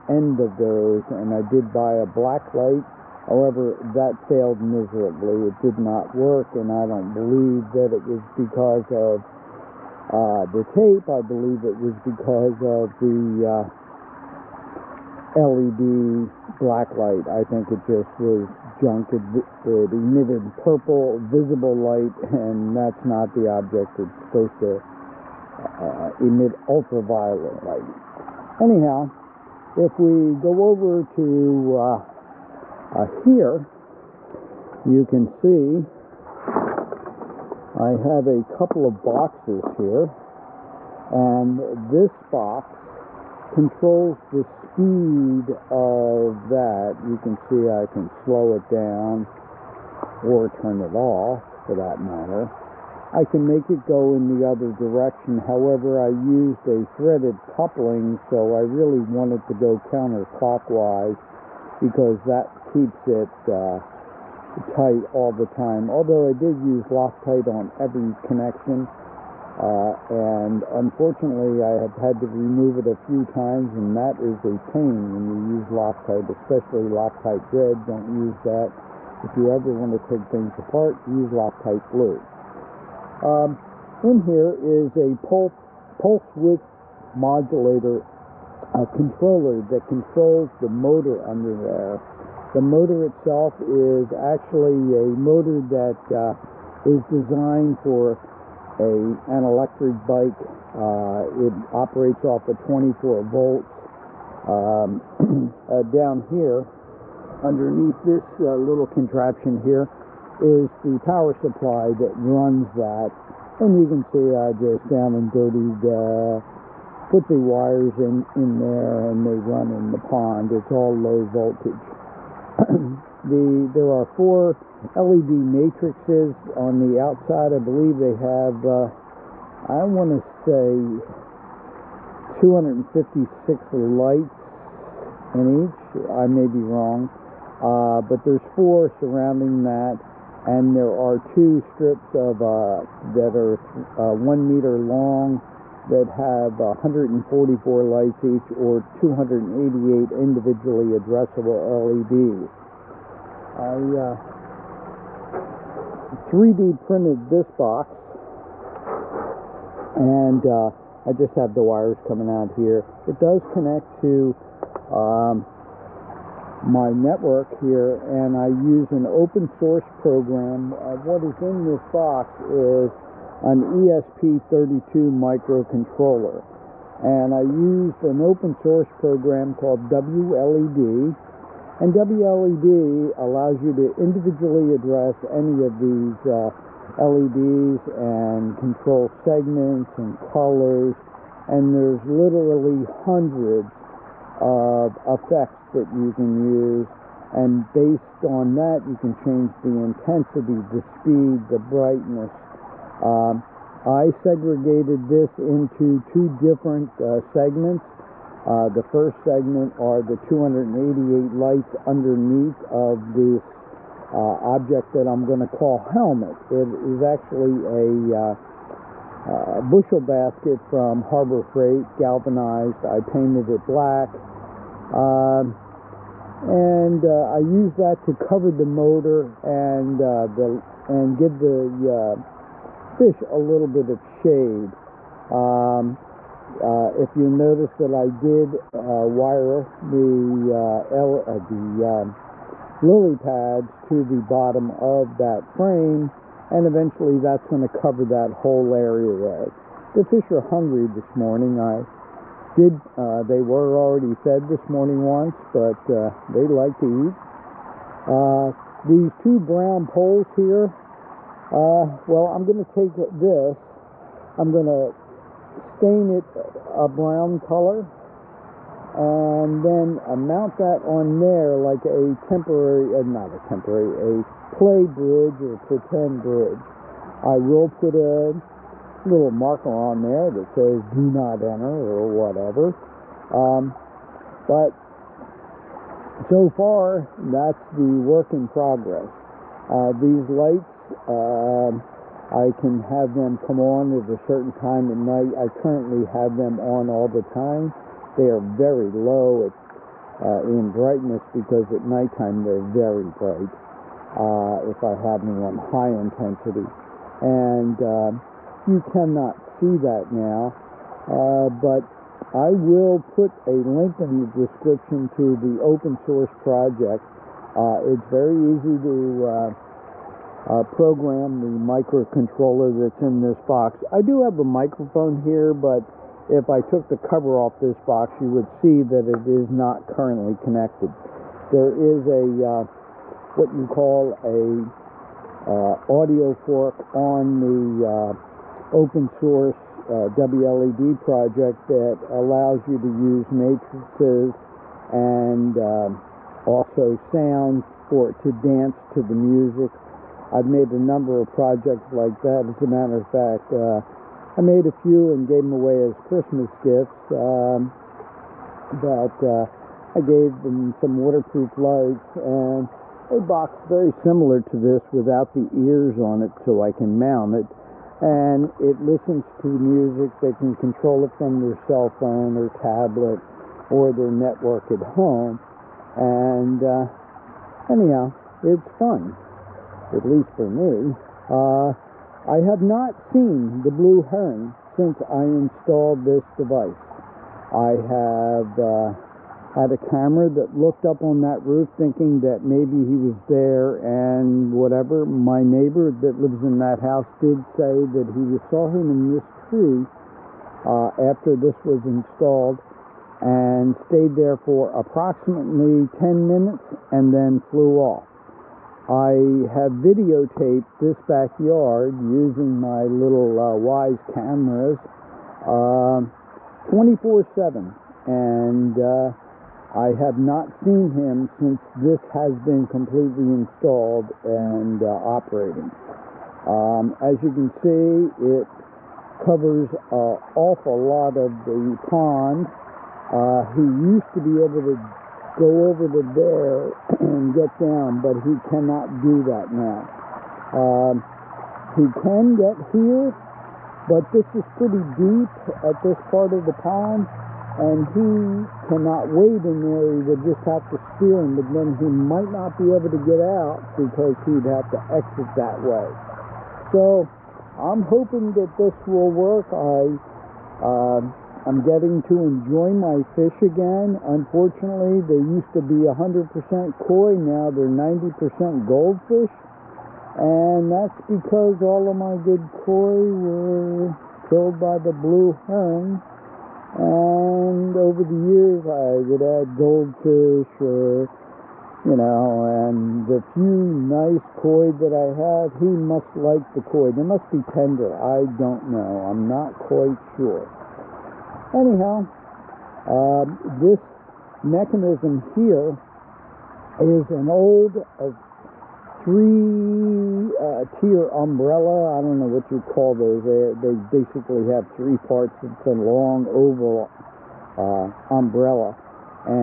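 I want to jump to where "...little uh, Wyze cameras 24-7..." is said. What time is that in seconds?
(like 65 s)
412 s.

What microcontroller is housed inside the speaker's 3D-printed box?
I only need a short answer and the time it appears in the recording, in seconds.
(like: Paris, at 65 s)
ESP32, at 173 s.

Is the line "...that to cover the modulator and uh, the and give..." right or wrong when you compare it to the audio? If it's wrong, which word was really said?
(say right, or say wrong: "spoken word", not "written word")
wrong: "motor", not "modulator".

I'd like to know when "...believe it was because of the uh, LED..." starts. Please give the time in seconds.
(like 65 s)
11 s.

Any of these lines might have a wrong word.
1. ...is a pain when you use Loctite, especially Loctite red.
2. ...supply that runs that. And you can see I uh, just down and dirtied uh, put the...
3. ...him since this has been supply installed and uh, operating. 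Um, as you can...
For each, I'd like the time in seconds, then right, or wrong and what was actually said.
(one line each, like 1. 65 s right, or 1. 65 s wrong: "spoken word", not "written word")
1. 74 s right
2. 111 s right
3. 420 s wrong: "completely", not "supply".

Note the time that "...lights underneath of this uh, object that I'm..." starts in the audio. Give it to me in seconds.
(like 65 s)
211 s.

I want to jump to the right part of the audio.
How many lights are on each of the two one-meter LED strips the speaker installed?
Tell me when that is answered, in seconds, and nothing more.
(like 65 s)
146 s.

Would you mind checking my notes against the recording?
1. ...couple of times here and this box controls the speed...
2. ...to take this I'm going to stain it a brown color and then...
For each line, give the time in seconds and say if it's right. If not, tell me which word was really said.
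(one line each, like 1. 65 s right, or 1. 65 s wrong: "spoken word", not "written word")
1. 38 s wrong: "boxes", not "times"
2. 262 s right.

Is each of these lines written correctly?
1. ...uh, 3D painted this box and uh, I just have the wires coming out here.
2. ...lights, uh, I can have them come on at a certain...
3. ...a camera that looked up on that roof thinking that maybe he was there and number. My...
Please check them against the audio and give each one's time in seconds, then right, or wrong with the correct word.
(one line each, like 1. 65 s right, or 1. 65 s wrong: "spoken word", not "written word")
1. 153 s wrong: "printed", not "painted"
2. 290 s right
3. 389 s wrong: "whatever", not "number".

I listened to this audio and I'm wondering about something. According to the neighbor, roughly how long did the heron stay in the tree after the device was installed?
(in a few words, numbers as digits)
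10 minutes.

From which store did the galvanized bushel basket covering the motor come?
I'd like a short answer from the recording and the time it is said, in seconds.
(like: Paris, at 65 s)
Harbor Freight, at 221 s.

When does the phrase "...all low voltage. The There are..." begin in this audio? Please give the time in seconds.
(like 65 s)
120 s.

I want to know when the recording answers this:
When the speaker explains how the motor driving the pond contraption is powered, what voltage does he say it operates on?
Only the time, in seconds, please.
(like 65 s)
102 s.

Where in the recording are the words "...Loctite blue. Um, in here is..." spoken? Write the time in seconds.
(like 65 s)
81 s.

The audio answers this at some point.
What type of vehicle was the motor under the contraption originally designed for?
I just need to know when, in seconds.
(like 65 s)
99 s.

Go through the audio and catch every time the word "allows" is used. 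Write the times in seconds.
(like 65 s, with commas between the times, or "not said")
183 s, 342 s.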